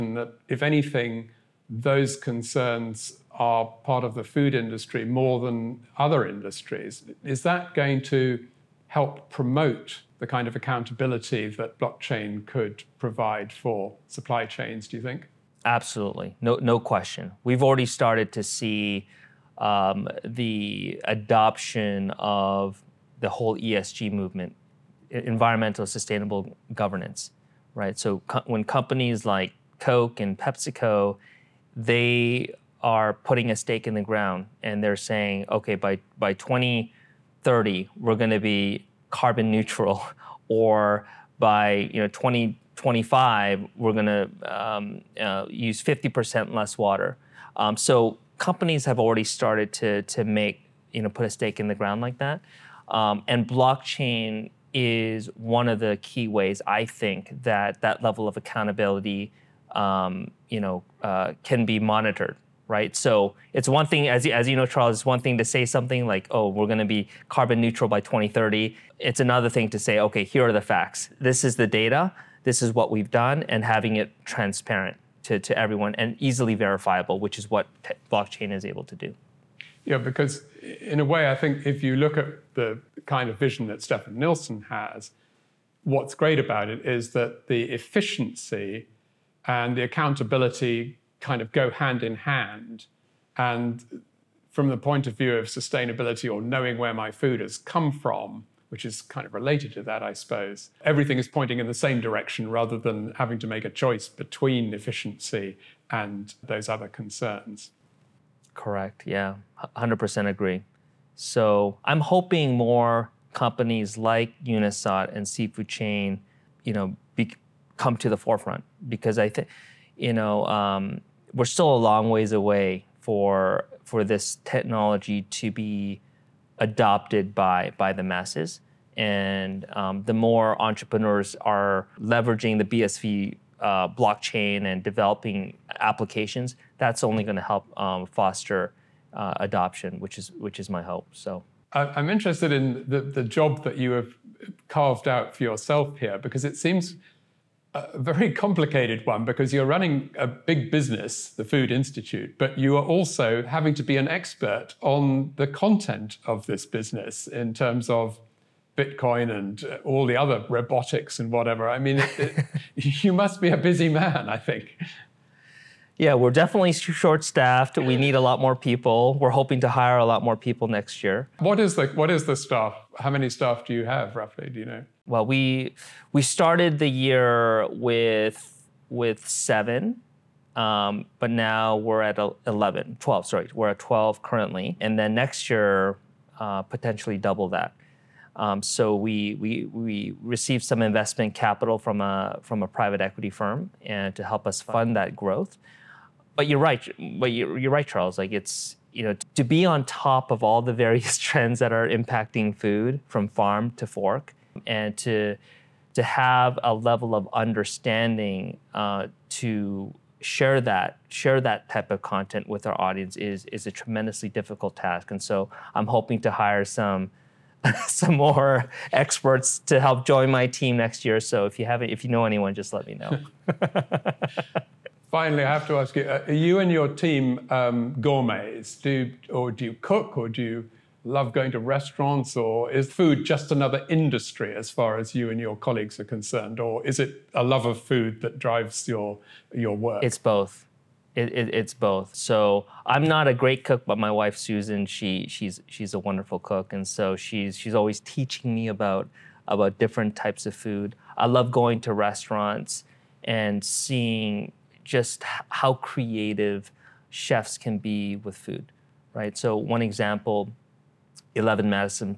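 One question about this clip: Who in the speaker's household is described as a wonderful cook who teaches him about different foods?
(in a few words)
Susan.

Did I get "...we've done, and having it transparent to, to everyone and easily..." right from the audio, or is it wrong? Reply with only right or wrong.
right.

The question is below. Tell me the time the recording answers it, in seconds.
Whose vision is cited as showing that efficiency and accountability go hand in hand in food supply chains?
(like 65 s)
83 s.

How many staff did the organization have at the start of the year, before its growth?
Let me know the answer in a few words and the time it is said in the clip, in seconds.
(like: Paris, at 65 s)
7, at 179 s.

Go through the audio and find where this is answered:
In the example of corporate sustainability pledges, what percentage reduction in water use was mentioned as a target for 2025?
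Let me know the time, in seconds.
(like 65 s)
45 s.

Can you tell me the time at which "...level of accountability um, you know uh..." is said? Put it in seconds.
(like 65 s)
58 s.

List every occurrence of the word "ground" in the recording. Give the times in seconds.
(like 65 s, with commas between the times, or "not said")
34 s, 51 s.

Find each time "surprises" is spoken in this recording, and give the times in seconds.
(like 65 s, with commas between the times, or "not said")
not said.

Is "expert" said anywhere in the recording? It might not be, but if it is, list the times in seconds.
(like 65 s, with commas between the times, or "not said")
154 s, 218 s.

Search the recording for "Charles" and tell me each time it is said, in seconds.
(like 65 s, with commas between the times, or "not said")
64 s, 197 s.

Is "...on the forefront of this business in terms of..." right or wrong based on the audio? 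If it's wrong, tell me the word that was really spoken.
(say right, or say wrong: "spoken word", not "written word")
wrong: "content", not "forefront".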